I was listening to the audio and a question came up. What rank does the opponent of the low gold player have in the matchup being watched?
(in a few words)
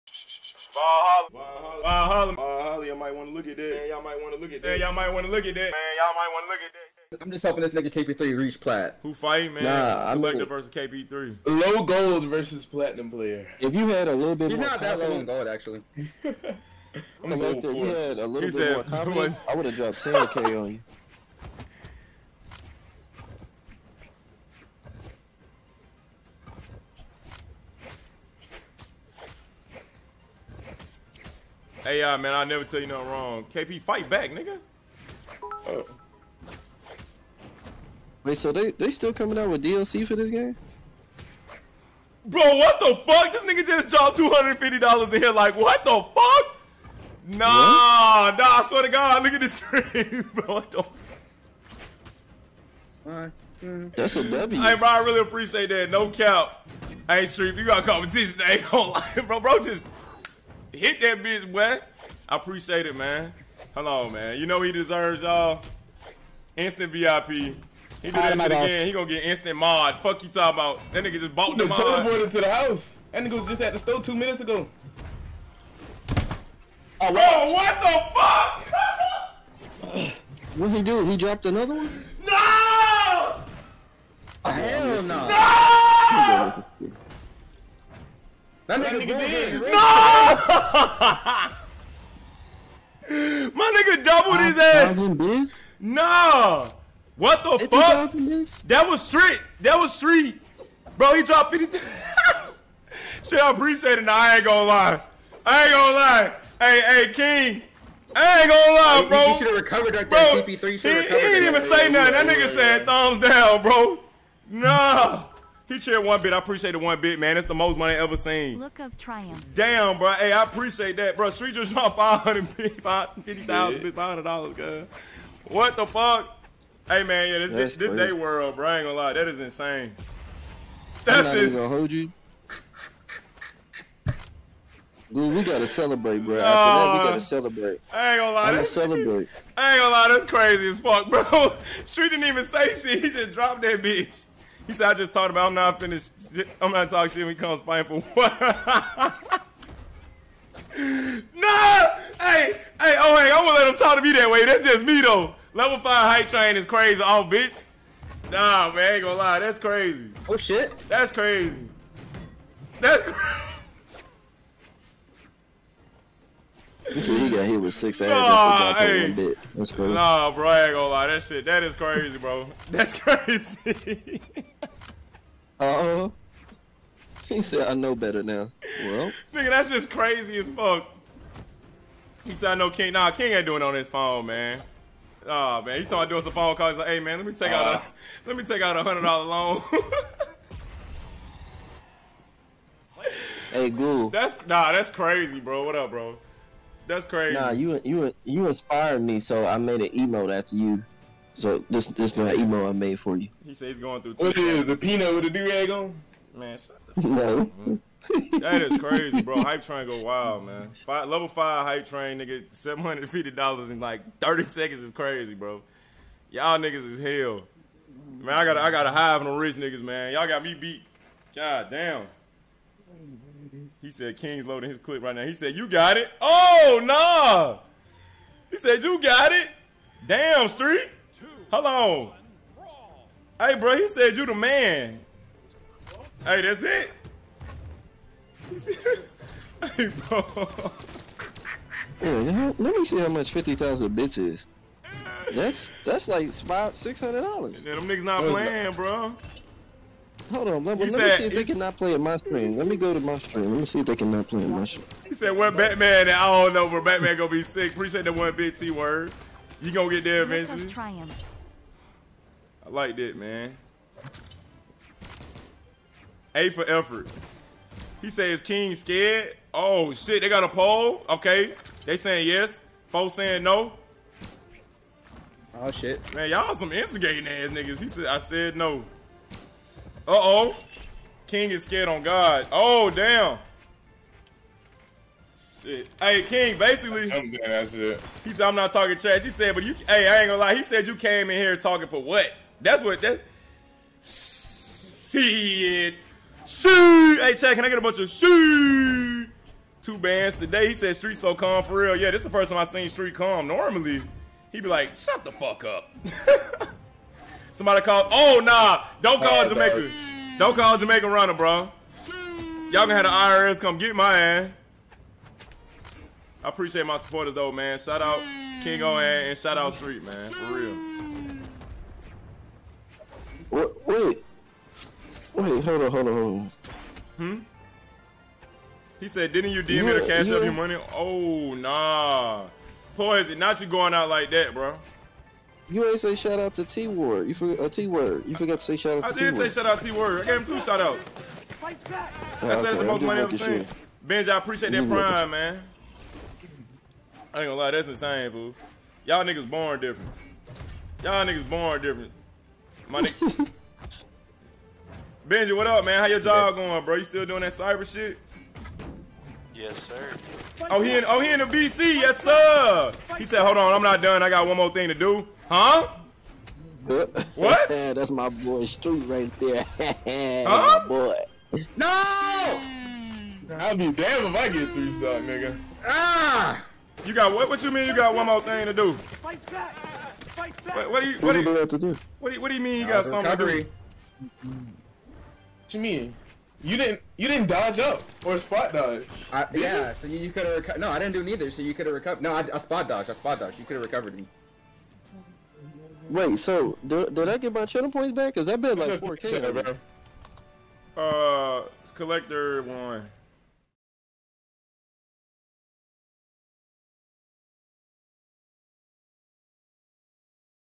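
Platinum.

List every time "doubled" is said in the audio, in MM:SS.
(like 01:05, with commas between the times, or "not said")
01:34.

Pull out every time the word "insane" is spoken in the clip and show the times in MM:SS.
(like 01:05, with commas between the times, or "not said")
02:09, 05:47.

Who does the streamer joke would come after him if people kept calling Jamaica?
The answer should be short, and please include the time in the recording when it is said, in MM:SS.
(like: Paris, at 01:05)
The IRS, at 05:13.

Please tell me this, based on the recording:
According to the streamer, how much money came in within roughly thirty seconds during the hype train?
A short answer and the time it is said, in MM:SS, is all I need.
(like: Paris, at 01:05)
$750, at 03:32.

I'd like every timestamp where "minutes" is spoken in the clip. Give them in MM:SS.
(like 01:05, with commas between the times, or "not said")
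01:14.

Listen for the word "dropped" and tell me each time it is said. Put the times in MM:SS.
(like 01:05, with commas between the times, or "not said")
00:19, 00:43, 01:21, 01:41, 02:01, 02:23.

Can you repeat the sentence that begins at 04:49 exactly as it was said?
He said, but you, hey, I ain't gonna lie.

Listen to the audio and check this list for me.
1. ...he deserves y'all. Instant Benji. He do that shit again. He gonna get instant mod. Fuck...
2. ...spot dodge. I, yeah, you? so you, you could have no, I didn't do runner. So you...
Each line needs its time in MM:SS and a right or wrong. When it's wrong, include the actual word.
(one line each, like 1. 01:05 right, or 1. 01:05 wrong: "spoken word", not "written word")
1. 01:04 wrong: "VIP", not "Benji"
2. 06:28 wrong: "neither", not "runner".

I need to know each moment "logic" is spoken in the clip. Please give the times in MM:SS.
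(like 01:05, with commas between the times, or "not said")
not said.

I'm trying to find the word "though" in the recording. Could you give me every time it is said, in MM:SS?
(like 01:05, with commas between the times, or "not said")
02:35, 05:17.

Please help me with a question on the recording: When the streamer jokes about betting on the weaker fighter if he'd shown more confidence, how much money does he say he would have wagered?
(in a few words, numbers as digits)
10k.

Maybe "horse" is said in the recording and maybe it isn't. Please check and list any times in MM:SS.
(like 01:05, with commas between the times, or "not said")
not said.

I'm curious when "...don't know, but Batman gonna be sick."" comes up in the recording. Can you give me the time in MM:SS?
04:16.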